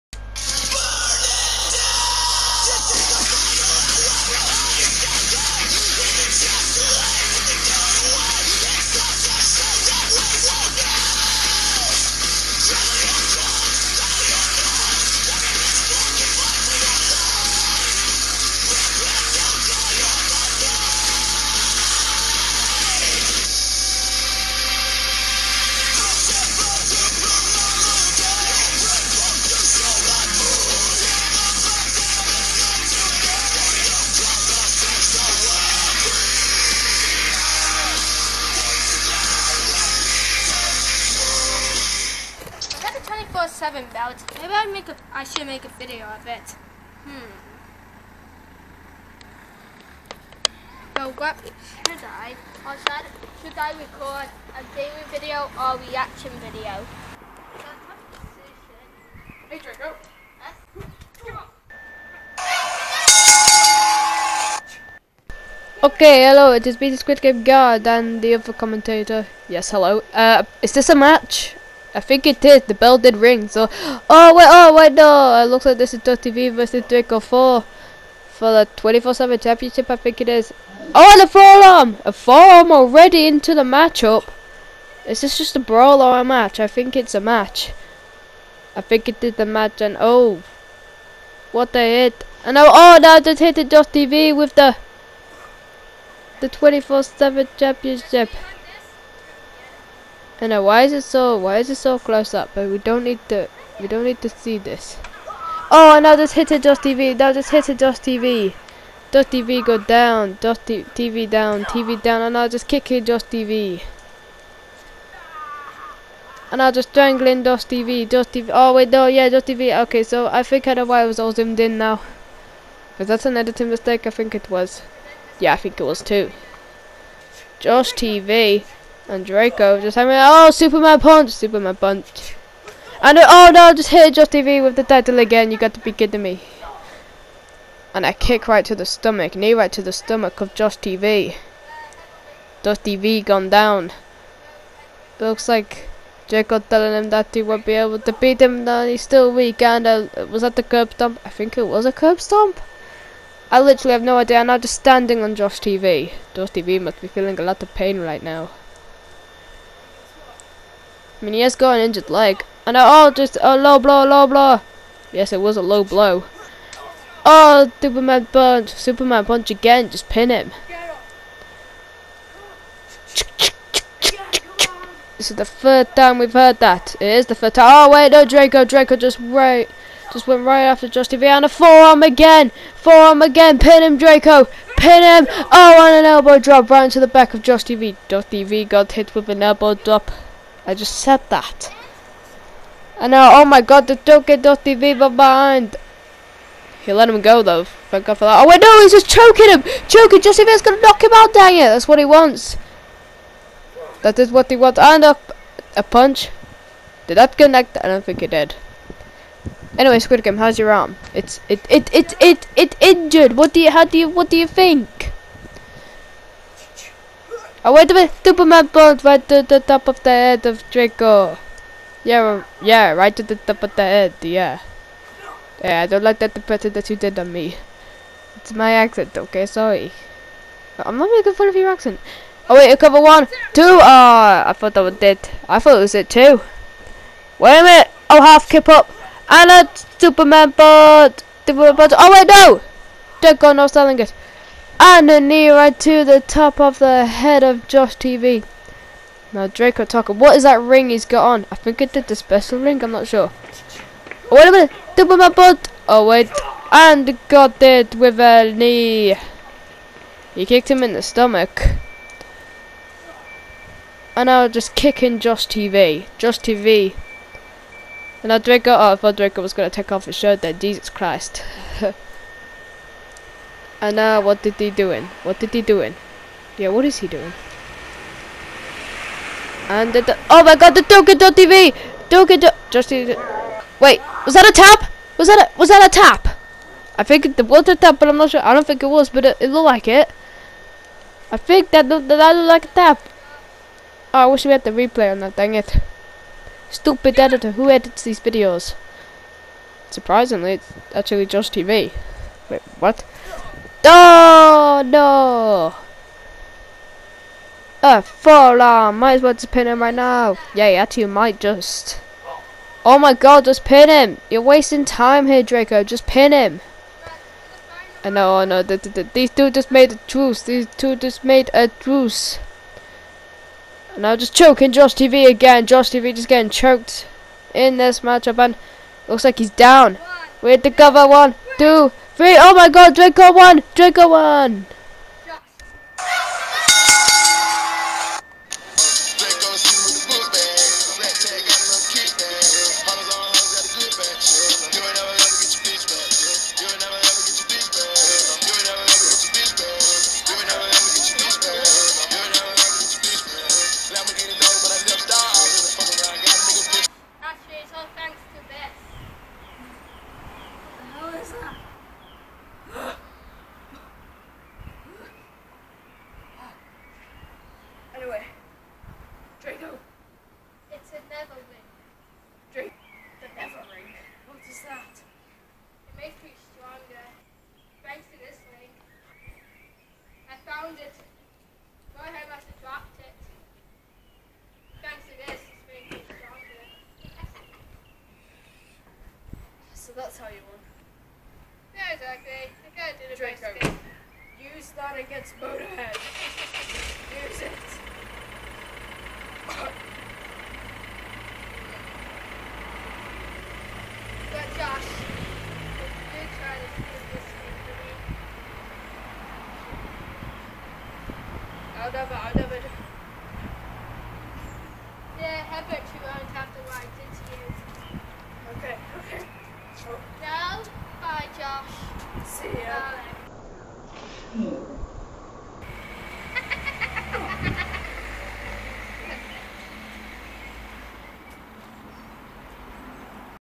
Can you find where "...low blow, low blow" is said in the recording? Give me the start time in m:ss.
2:43.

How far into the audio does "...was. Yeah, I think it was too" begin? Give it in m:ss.
2:04.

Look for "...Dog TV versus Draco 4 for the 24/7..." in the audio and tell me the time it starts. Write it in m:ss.
1:16.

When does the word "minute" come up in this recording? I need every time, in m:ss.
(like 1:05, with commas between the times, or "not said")
3:57, 4:14.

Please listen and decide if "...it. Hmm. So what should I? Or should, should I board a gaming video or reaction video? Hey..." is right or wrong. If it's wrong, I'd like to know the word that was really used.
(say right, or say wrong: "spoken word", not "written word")
wrong: "record", not "board".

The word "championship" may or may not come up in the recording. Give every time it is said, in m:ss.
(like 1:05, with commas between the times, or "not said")
1:19, 1:37.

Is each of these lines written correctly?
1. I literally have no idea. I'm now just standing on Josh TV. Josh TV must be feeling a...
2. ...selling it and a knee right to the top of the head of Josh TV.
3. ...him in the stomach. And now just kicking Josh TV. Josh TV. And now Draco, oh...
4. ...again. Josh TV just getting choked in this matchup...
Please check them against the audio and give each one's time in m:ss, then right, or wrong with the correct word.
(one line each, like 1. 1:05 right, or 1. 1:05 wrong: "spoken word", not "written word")
1. 2:33 right
2. 4:03 right
3. 4:20 right
4. 5:25 right.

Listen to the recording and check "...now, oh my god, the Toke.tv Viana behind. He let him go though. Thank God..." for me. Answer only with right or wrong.
wrong.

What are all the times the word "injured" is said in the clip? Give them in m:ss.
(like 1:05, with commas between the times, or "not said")
2:41, 3:32.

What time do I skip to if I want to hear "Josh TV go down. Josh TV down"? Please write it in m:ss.
1:49.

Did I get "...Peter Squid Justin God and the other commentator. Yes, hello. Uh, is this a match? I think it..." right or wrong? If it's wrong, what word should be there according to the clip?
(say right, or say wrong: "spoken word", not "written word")
wrong: "Game", not "Justin".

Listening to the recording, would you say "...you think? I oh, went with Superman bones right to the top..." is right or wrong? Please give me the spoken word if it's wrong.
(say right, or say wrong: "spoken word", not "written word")
right.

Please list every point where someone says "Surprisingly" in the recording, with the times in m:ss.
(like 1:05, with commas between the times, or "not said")
4:59.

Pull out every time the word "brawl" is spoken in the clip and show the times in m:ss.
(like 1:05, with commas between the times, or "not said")
1:25.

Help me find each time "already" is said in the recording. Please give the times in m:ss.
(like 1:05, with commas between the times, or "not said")
1:22.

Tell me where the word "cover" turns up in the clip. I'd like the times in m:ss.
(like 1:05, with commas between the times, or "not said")
3:52, 5:30.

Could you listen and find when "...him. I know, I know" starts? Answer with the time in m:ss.
5:16.